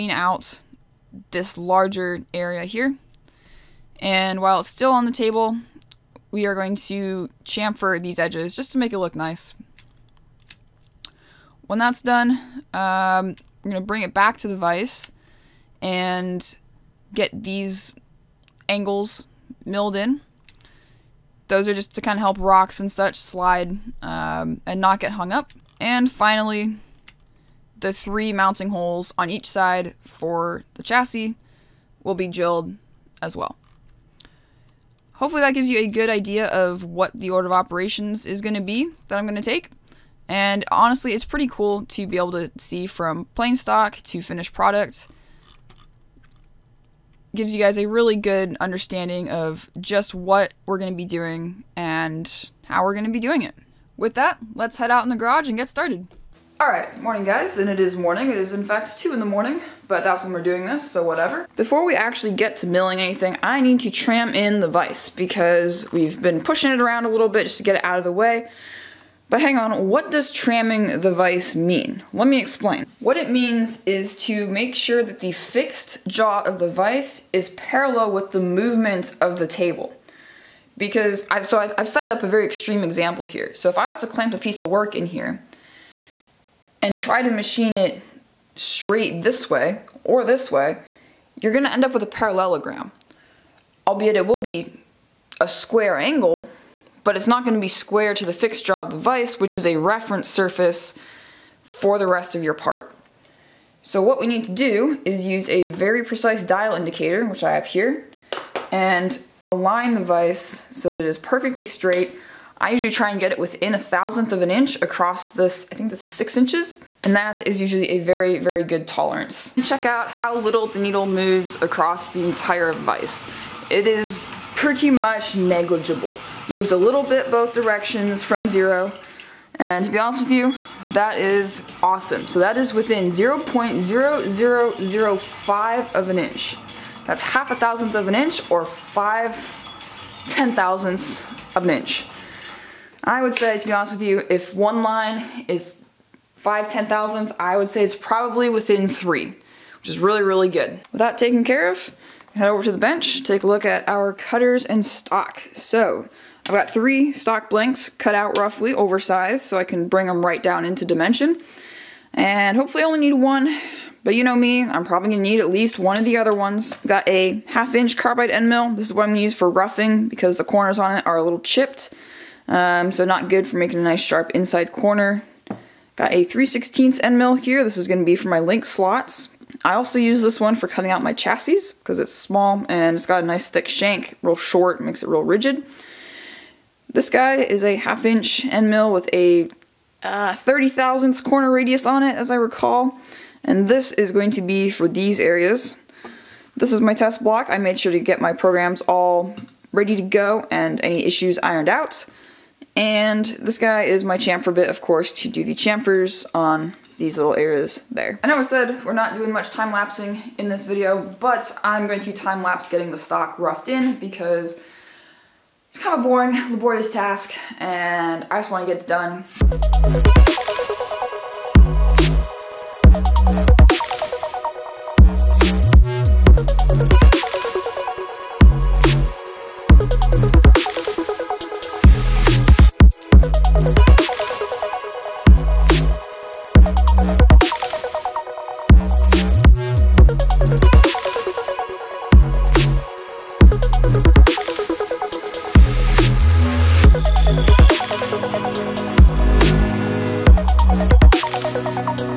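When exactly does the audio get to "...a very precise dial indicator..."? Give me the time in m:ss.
1:45.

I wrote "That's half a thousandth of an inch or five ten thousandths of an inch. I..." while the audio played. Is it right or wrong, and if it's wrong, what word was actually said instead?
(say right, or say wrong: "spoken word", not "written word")
right.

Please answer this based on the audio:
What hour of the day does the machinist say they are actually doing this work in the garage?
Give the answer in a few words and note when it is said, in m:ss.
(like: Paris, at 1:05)
2 in the morning, at 0:58.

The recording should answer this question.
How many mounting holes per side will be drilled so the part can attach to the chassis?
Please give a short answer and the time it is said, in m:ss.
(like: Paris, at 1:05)
3, at 0:27.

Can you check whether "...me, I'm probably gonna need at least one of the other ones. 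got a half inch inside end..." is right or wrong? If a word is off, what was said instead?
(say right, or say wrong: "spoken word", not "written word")
wrong: "carbide", not "inside".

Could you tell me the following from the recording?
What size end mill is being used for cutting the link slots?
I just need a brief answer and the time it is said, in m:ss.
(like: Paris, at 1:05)
3/16, at 2:56.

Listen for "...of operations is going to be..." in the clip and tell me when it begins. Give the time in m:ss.
0:37.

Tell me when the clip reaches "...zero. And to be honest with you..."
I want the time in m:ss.
2:08.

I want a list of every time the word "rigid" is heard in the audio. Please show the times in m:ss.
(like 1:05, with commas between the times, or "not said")
3:05.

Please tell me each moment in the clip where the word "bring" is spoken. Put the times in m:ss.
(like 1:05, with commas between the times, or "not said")
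0:13, 2:39.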